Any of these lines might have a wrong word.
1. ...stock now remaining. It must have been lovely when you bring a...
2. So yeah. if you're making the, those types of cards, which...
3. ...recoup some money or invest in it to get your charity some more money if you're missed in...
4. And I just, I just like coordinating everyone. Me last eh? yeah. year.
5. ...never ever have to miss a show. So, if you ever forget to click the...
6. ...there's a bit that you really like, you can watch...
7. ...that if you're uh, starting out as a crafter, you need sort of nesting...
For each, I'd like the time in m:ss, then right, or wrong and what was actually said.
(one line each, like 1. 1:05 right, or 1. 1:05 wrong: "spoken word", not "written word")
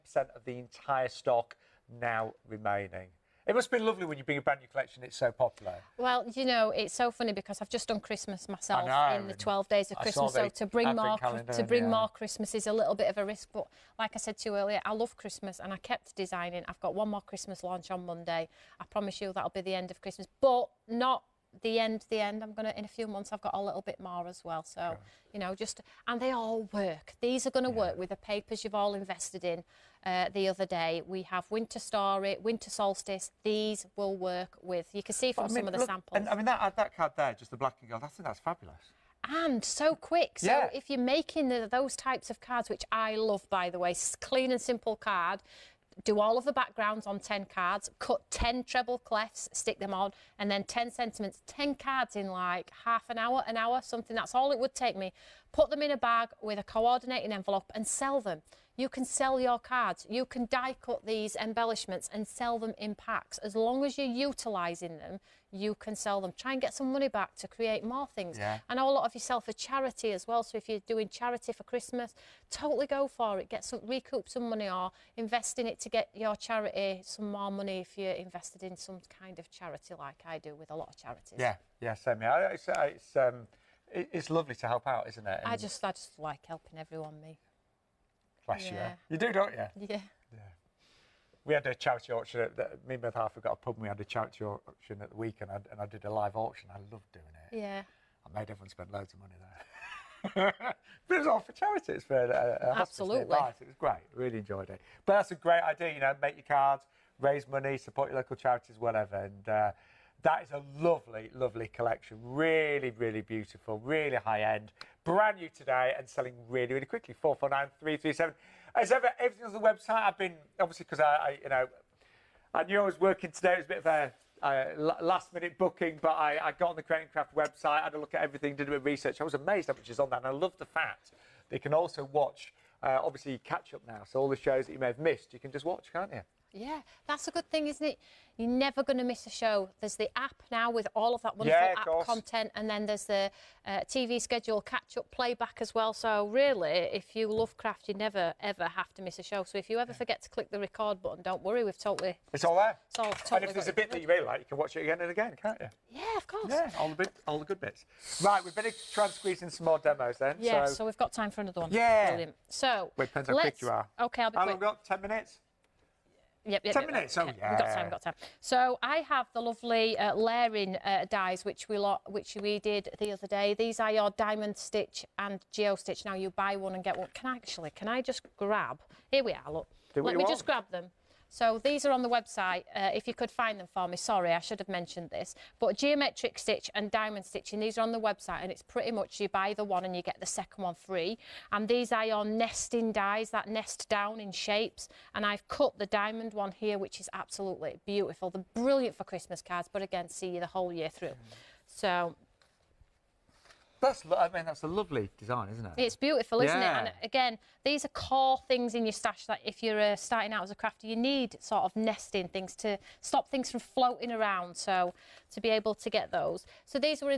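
1. 0:01 right
2. 0:40 right
3. 1:13 wrong: "invested", not "missed"
4. 1:25 wrong: "helping", not "coordinating"
5. 2:27 right
6. 2:33 right
7. 3:29 right.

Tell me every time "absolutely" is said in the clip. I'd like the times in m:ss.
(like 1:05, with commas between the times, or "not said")
1:42, 3:17.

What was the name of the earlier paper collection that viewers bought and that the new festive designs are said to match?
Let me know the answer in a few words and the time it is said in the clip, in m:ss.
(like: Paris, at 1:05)
Winter Solstice, at 0:32.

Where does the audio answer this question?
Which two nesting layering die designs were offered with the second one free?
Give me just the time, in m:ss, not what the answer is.
2:54.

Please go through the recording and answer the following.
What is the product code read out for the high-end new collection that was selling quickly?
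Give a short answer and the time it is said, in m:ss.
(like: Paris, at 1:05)
449337, at 1:57.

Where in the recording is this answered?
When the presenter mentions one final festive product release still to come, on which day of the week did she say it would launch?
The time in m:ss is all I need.
0:18.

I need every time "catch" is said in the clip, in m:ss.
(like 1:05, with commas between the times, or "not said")
2:13, 2:24.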